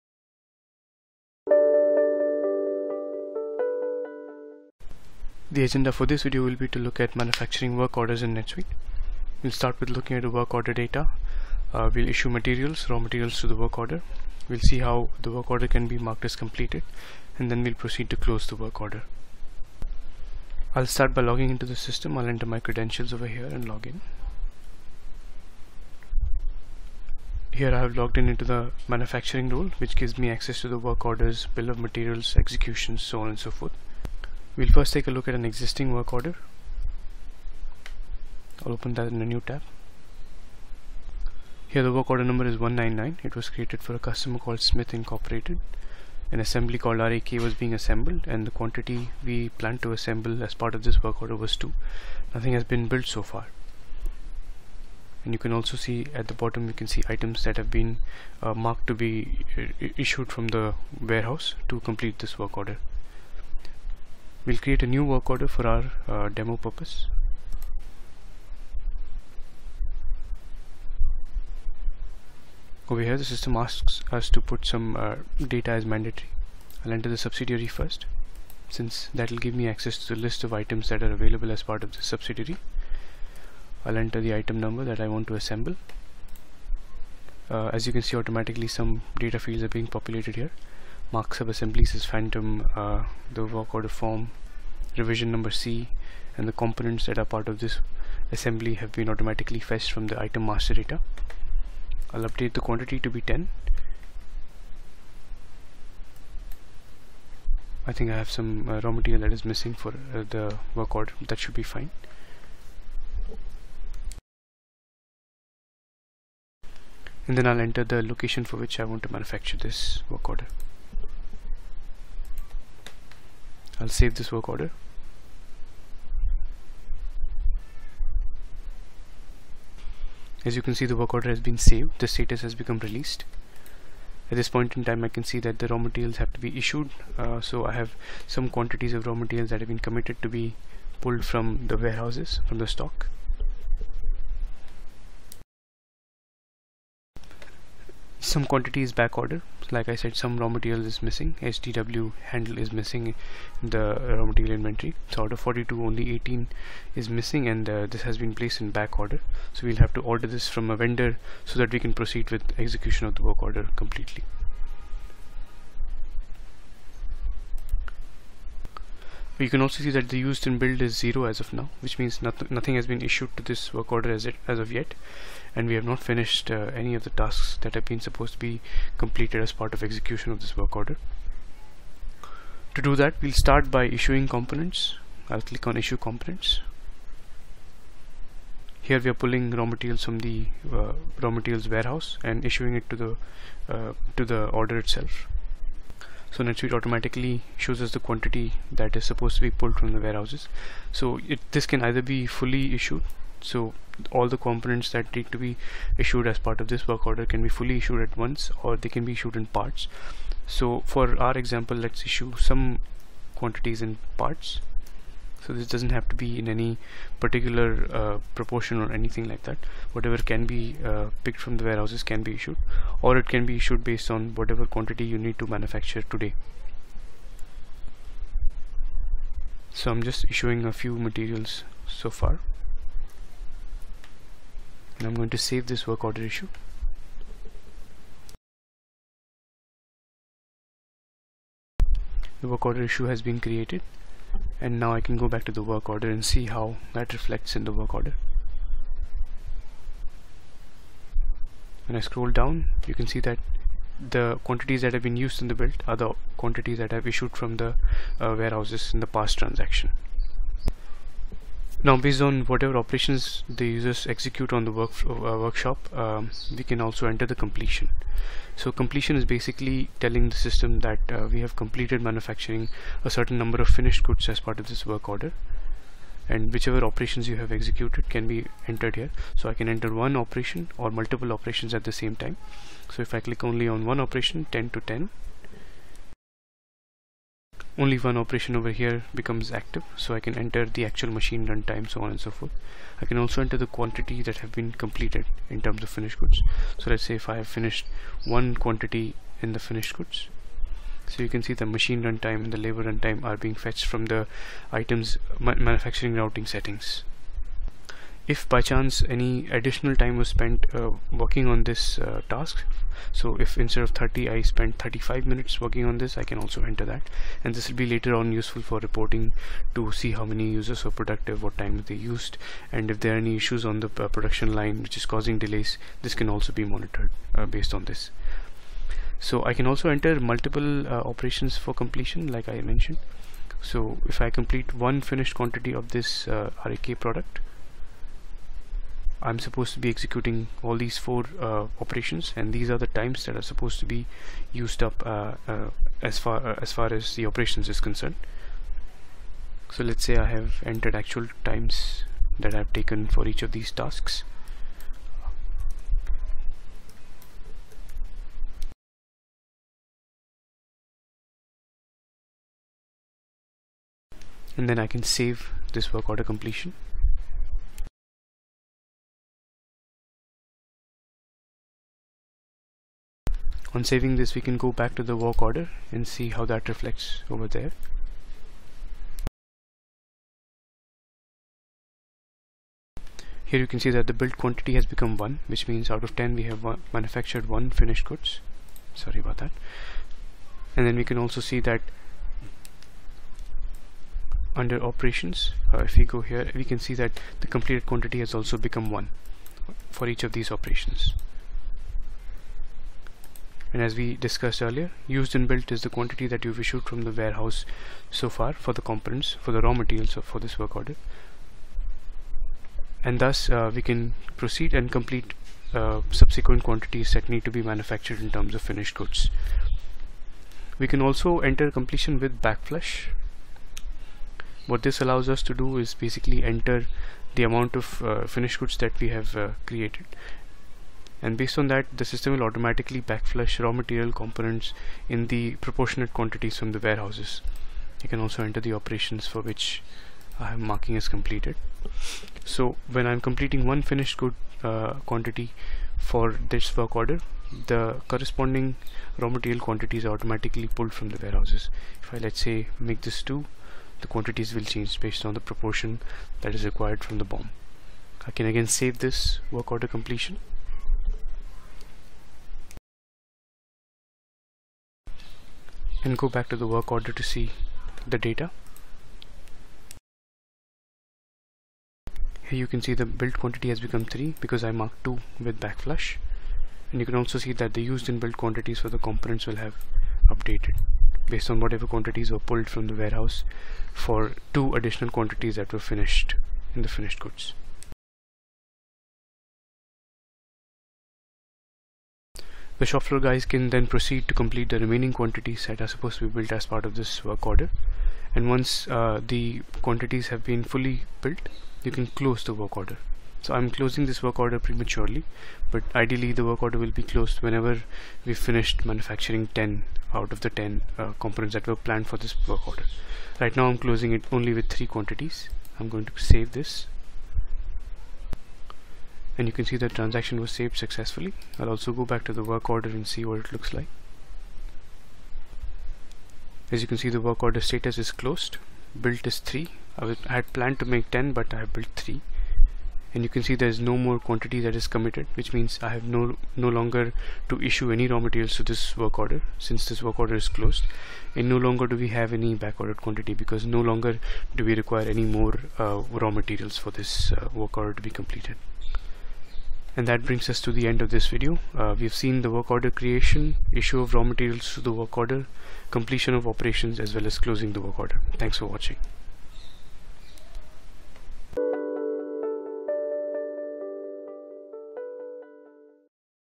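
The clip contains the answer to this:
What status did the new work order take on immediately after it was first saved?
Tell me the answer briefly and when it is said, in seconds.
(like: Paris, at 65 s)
released, at 132 s.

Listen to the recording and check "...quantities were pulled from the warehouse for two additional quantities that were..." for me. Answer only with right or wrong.
right.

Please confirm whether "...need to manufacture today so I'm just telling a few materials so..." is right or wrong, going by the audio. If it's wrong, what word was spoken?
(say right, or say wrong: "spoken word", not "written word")
wrong: "issuing", not "telling".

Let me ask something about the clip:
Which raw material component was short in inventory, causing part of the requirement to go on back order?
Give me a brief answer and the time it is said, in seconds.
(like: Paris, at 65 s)
STW handle, at 151 s.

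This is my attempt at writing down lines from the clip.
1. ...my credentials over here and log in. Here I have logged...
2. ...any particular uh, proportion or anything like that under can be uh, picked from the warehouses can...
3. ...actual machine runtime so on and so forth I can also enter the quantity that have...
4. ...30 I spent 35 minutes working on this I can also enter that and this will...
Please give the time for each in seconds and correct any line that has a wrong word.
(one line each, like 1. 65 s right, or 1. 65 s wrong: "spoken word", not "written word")
1. 22 s right
2. 216 s wrong: "whatever", not "under"
3. 290 s right
4. 313 s right.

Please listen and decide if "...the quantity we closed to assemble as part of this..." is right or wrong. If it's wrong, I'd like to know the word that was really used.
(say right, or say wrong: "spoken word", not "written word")
wrong: "planned", not "closed".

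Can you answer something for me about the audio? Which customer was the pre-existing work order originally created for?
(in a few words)
Smith Incorporated.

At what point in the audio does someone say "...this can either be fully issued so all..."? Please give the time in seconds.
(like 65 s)
201 s.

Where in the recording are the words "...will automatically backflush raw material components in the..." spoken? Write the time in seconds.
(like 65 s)
432 s.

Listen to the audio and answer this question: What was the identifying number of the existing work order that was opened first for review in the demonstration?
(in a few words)
199.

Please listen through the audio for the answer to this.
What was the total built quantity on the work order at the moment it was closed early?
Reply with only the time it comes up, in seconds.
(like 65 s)
514 s.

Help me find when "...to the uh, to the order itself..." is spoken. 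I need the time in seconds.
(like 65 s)
192 s.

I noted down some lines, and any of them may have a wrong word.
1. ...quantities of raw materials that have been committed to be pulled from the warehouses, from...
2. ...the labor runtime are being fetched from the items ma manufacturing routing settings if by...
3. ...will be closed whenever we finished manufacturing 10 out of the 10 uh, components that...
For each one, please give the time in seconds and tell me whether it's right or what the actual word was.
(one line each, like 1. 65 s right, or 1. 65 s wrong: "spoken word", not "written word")
1. 138 s right
2. 302 s right
3. 506 s right.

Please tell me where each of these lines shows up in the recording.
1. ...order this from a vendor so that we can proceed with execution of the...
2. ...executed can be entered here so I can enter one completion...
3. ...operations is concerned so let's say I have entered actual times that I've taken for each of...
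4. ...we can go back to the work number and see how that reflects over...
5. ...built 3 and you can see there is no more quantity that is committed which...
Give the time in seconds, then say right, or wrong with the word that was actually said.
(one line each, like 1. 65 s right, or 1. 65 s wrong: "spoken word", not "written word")
1. 160 s right
2. 277 s wrong: "operation", not "completion"
3. 347 s right
4. 374 s wrong: "order", not "number"
5. 531 s right.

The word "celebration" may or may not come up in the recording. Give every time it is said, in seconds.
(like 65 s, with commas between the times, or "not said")
not said.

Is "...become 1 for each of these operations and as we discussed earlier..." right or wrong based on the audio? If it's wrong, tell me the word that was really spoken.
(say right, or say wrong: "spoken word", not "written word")
right.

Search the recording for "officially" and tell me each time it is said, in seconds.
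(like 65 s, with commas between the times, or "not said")
not said.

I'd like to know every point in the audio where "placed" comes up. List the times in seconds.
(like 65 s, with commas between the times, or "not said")
158 s.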